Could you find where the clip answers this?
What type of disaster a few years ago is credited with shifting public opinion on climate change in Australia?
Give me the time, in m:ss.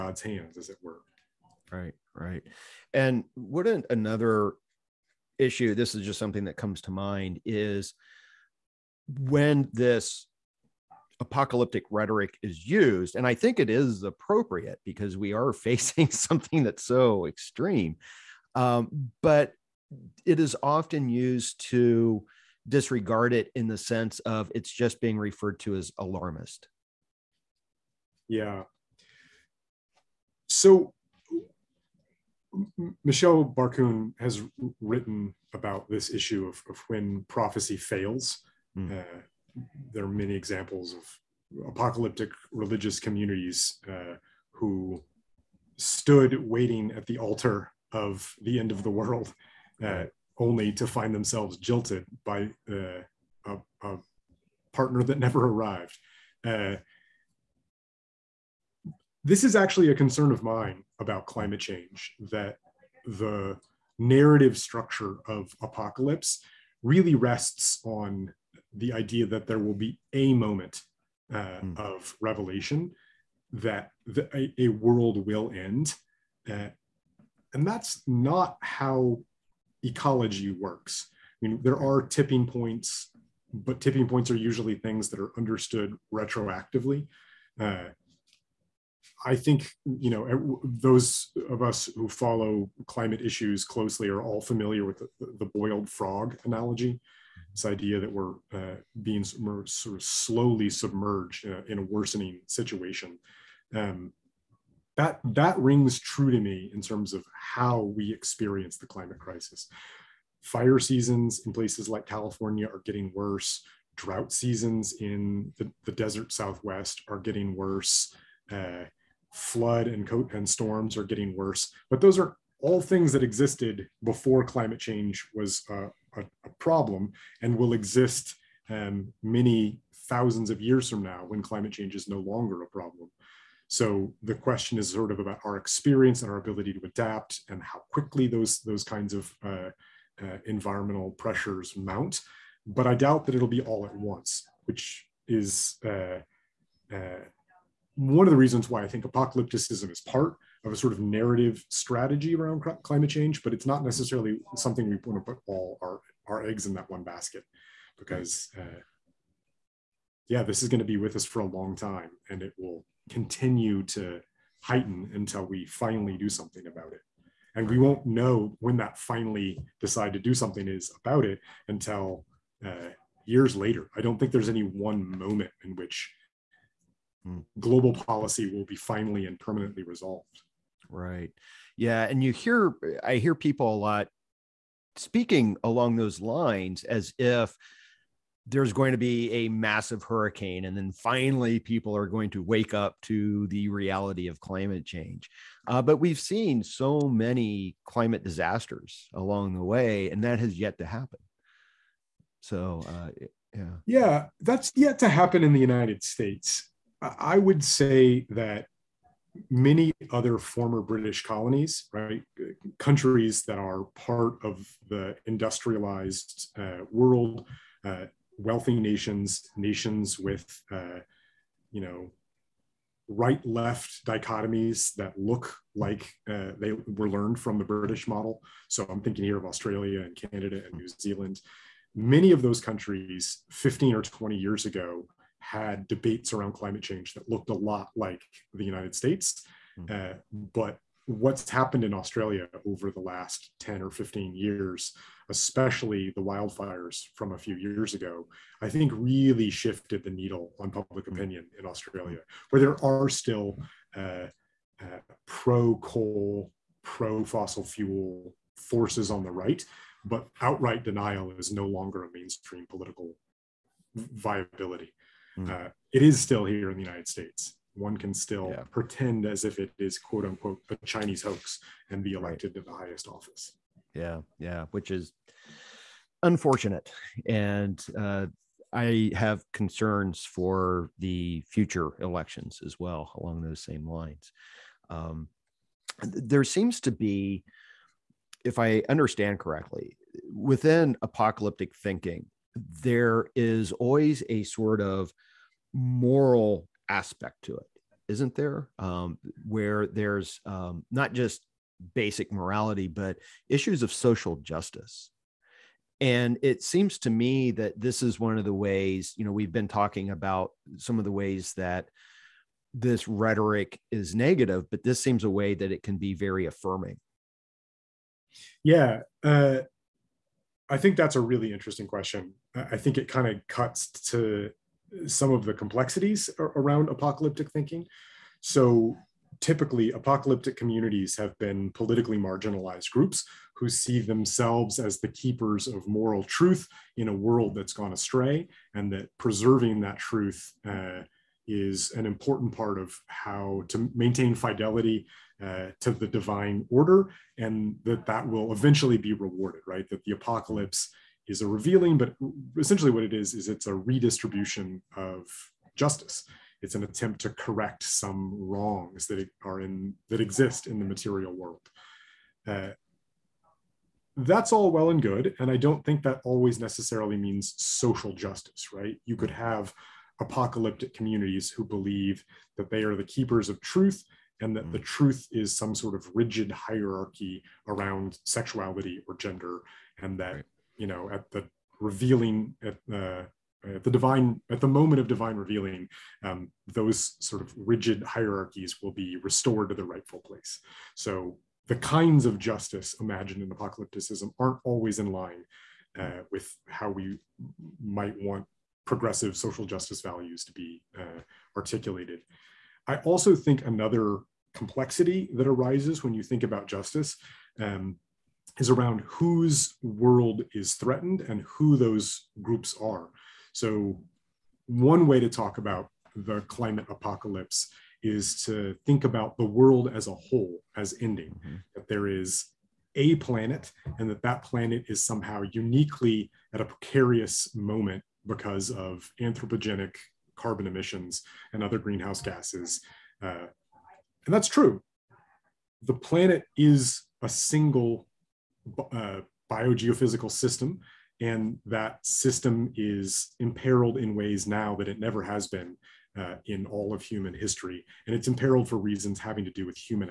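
4:06.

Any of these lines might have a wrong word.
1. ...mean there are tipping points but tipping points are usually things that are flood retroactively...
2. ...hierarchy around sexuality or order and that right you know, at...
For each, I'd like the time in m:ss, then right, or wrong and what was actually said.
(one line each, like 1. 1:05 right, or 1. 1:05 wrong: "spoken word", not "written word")
1. 1:21 wrong: "understood", not "flood"
2. 6:16 wrong: "gender", not "order".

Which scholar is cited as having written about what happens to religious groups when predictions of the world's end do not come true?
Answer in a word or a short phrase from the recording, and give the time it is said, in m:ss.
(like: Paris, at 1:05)
Michael Barkun, at 0:33.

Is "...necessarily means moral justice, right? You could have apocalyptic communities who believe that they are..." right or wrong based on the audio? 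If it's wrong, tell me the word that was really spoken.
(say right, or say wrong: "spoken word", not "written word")
wrong: "social", not "moral".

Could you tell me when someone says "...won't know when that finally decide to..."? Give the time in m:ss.
2:47.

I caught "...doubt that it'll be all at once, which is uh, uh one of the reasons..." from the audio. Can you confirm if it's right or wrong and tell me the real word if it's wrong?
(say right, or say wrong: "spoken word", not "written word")
right.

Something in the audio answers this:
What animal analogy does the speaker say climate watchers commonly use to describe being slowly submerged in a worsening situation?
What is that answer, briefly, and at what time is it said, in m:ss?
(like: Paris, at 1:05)
boiled frog, at 1:35.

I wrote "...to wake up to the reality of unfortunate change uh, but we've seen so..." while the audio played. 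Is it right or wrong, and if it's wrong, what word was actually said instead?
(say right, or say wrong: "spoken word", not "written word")
wrong: "climate", not "unfortunate".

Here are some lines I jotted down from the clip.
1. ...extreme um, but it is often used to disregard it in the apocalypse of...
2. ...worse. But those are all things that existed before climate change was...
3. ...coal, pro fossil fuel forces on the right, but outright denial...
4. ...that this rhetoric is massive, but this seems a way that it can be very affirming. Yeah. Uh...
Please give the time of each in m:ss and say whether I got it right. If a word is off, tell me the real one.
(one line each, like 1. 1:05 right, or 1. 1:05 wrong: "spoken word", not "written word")
1. 0:17 wrong: "sense", not "apocalypse"
2. 2:01 right
3. 4:15 right
4. 5:11 wrong: "negative", not "massive".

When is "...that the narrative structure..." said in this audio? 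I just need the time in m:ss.
1:02.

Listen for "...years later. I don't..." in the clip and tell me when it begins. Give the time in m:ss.
2:53.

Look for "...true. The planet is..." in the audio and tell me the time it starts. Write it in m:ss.
7:14.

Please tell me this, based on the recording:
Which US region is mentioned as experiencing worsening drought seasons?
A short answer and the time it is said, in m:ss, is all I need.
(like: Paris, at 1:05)
desert Southwest, at 1:55.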